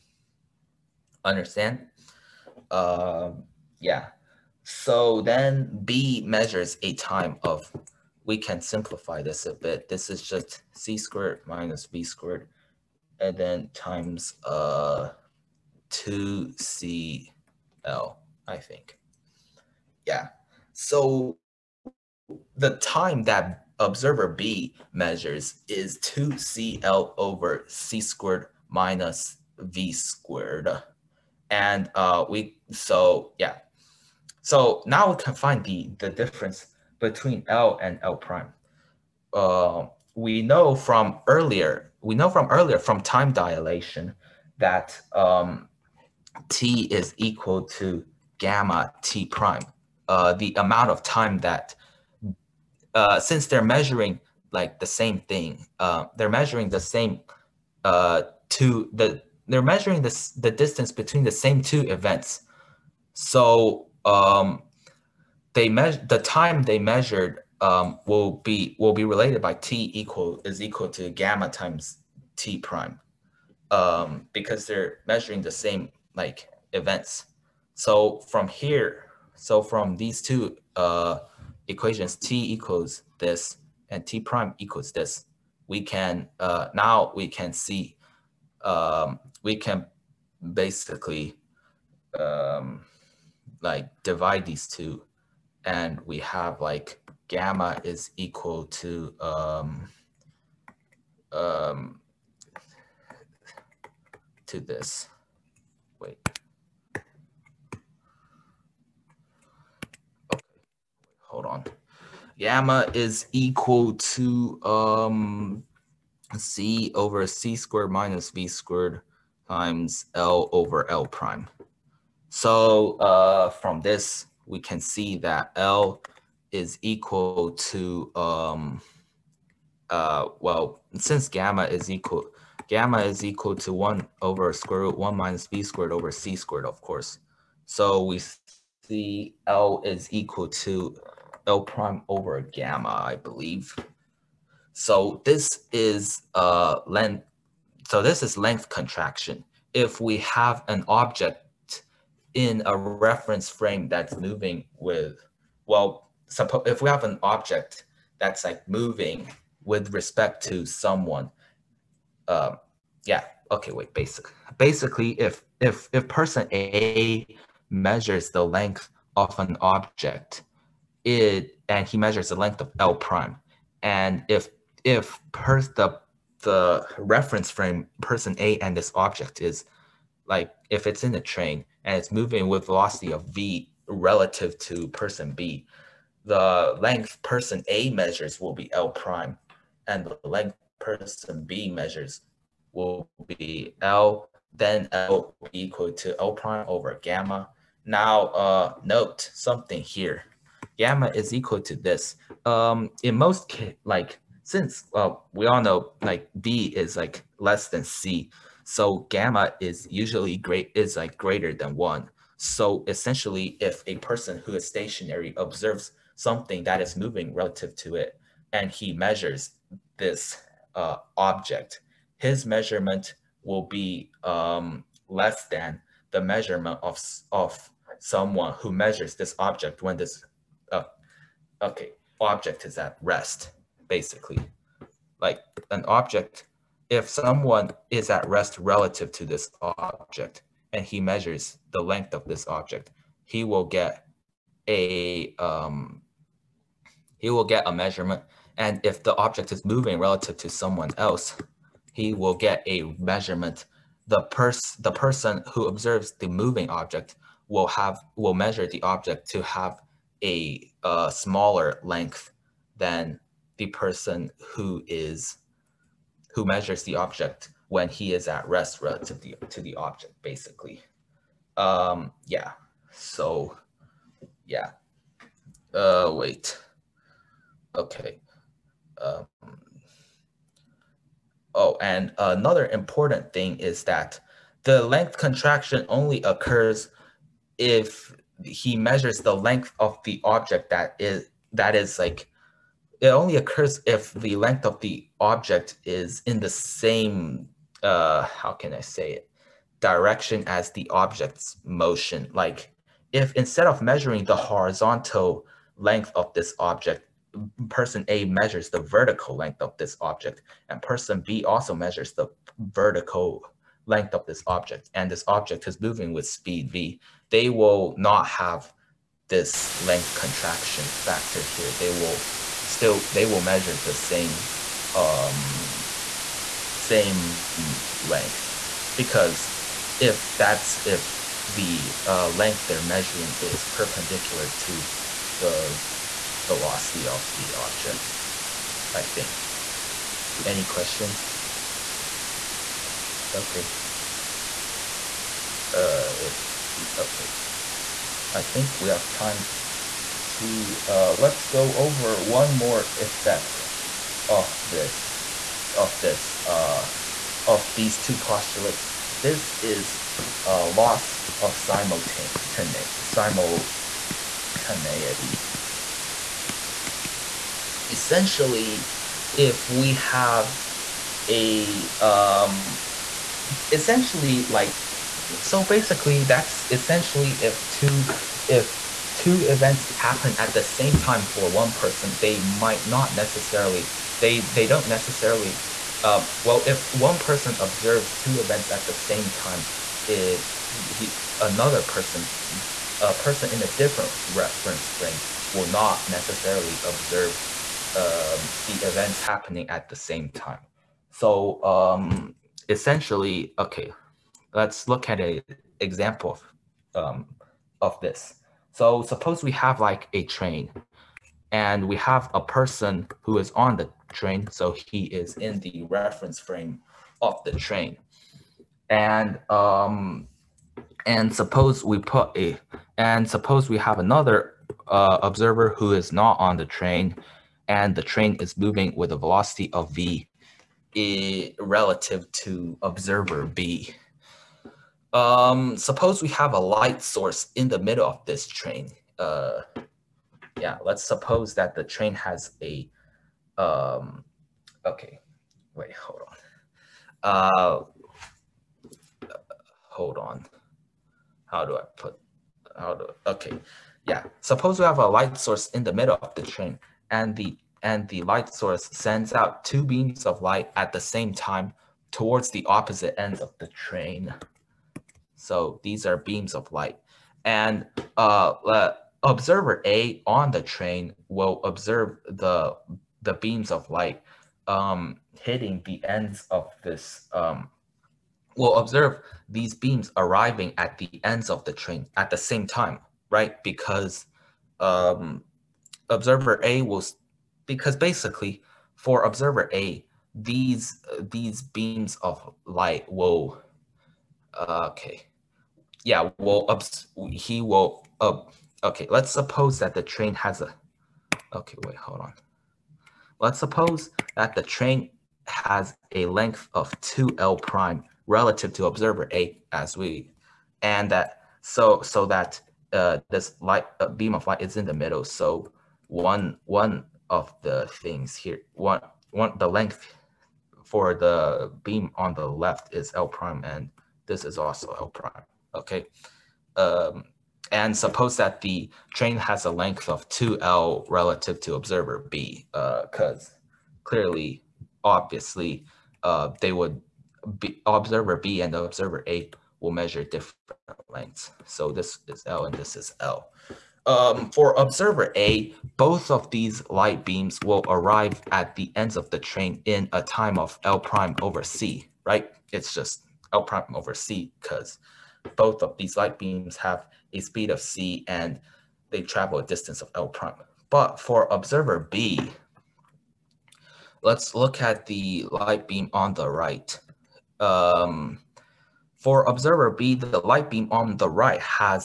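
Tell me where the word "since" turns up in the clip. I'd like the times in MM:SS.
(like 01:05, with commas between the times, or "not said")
00:53, 02:10, 03:24.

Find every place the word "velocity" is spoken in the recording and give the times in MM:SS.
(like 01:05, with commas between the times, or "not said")
03:02, 05:36, 07:09.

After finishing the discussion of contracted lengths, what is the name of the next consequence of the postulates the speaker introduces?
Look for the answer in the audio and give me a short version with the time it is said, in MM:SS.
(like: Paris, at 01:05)
loss of simultaneity, at 06:00.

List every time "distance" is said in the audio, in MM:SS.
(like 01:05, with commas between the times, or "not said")
01:00, 09:19.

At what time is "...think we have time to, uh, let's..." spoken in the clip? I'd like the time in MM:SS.
05:48.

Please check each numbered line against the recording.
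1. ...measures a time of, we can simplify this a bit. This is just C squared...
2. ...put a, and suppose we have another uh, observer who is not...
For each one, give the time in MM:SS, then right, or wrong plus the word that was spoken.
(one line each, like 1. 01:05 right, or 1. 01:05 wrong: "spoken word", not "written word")
1. 00:06 right
2. 07:01 right.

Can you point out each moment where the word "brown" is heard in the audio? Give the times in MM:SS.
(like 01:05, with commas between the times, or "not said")
not said.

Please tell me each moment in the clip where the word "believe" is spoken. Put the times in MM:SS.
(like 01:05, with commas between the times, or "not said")
02:23.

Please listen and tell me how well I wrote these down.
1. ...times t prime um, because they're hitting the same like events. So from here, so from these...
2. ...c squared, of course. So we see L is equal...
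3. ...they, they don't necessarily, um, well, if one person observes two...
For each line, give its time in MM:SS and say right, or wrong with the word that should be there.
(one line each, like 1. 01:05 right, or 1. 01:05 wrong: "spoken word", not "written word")
1. 01:11 wrong: "measuring", not "hitting"
2. 02:16 right
3. 06:24 right.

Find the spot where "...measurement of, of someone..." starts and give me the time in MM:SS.
03:46.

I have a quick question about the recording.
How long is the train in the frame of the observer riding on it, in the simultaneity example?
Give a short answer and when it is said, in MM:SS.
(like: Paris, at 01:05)
2L prime, at 08:27.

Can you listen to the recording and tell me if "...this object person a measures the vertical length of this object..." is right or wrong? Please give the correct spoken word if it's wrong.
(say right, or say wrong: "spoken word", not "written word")
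right.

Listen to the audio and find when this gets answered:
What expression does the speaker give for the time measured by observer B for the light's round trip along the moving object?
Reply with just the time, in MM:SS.
00:25.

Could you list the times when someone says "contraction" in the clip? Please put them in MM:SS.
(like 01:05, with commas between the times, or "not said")
02:28, 04:45, 05:20.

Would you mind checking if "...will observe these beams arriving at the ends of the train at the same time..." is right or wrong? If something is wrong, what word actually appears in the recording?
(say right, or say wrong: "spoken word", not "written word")
right.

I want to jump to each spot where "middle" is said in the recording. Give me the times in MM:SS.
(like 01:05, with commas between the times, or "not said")
07:17, 07:35, 08:34.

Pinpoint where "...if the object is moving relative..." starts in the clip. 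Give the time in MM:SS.
04:08.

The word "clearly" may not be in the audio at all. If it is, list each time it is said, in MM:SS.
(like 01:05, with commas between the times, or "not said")
08:54.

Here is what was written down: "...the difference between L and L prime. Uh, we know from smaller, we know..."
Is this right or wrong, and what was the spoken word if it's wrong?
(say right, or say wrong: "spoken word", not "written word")
wrong: "earlier", not "smaller".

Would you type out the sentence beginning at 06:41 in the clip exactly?
So um, essentially, okay, let's look at an example of, um, of this.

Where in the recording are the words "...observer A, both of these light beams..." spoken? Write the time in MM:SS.
09:04.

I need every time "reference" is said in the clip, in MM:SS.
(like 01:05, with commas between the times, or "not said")
02:32, 02:56, 06:34, 06:55.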